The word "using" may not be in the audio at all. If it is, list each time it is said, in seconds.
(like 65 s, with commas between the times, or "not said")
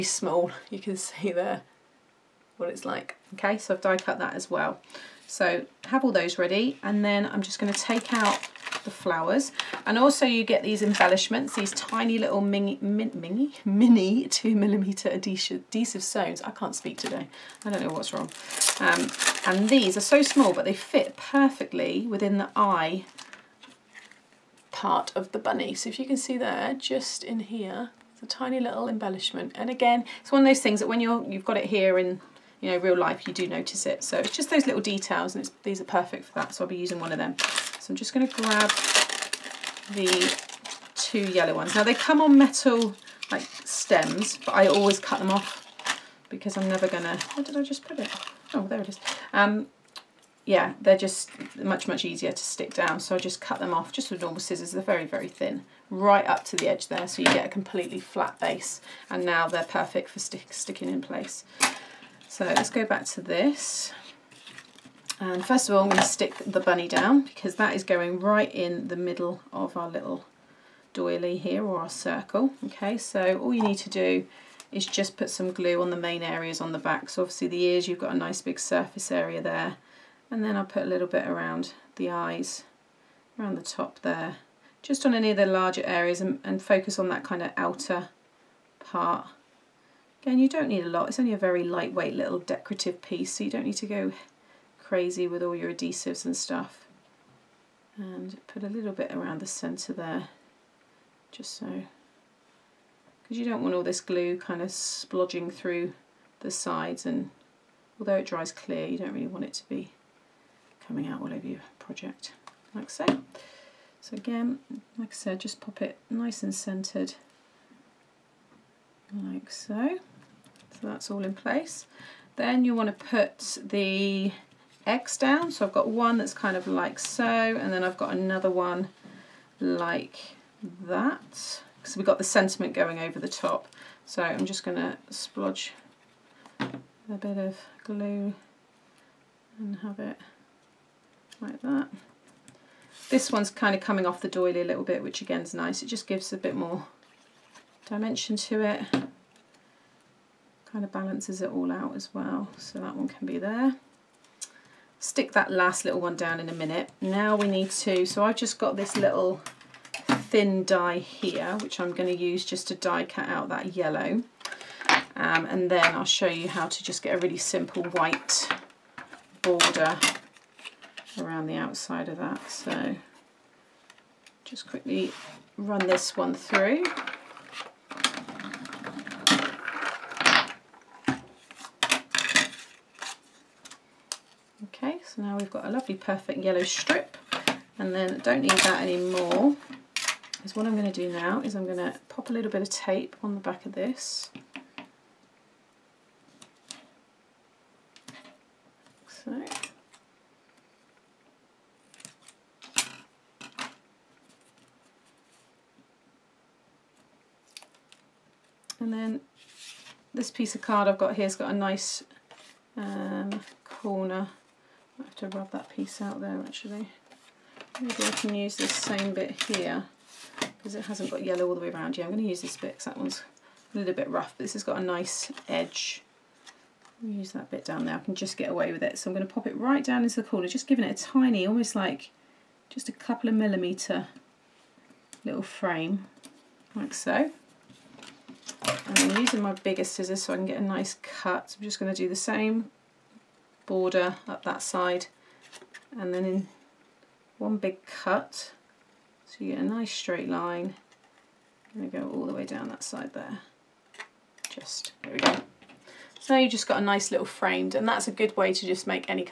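36 s, 239 s.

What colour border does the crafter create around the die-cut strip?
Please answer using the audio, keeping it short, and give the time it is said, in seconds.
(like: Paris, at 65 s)
white, at 167 s.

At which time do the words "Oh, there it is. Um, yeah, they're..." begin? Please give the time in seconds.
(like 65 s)
48 s.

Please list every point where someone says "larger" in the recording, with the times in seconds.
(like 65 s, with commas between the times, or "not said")
85 s.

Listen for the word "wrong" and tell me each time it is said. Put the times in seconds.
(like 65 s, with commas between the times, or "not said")
18 s.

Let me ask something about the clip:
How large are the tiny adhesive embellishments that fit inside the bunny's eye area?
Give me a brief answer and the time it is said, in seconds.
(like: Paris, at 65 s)
2 millimeter, at 14 s.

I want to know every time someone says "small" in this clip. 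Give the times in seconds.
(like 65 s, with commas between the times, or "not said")
0 s, 20 s.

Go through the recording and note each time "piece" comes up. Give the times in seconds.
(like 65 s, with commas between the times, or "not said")
93 s, 210 s, 215 s.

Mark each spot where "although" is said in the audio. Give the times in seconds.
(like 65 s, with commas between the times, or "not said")
107 s.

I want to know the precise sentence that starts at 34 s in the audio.
So it's just those little details and these are perfect for that.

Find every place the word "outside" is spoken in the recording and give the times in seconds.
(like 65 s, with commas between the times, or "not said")
171 s.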